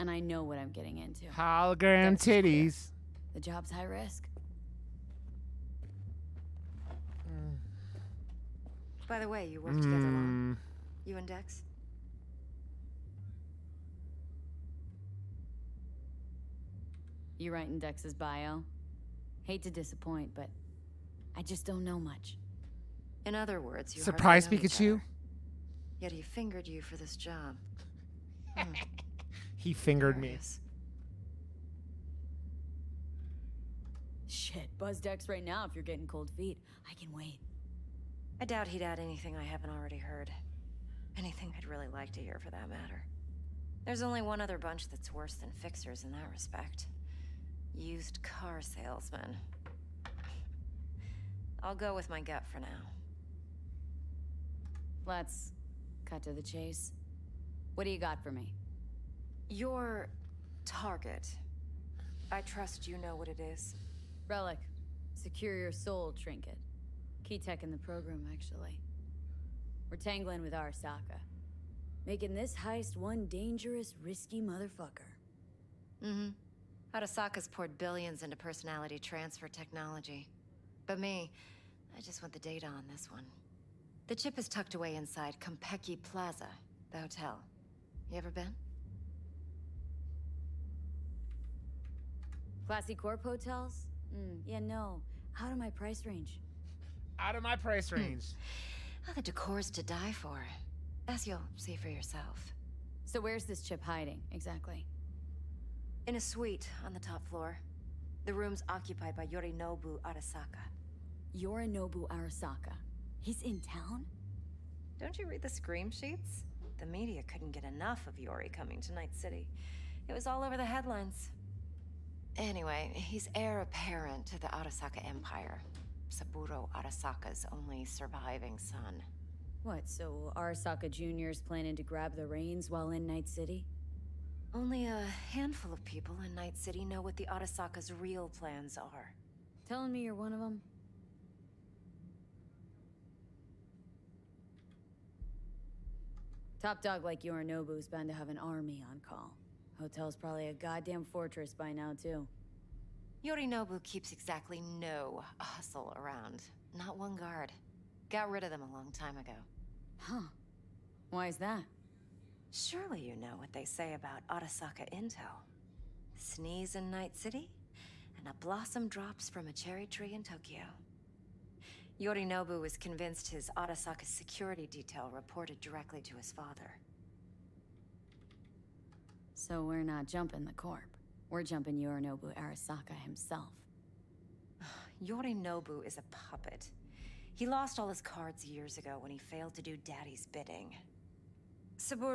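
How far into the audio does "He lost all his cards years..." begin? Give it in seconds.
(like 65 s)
187 s.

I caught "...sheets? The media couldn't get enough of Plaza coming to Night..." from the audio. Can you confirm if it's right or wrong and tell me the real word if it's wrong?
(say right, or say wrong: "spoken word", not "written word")
wrong: "Yori", not "Plaza".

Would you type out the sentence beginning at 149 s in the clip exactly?
Hotel's probably a goddamn fortress by now, too.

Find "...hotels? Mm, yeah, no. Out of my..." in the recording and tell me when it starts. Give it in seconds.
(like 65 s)
93 s.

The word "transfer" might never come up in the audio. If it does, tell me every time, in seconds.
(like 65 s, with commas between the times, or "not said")
78 s.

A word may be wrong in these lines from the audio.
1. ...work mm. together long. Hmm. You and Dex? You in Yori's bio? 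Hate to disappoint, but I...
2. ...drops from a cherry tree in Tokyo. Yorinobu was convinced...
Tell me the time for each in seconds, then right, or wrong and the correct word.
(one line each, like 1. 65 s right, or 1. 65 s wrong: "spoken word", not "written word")
1. 9 s wrong: "Dex", not "Yori"
2. 168 s right.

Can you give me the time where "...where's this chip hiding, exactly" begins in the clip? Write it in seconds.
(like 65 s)
103 s.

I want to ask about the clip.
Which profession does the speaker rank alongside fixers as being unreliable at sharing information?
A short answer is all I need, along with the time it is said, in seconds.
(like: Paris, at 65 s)
Used car salesmen, at 47 s.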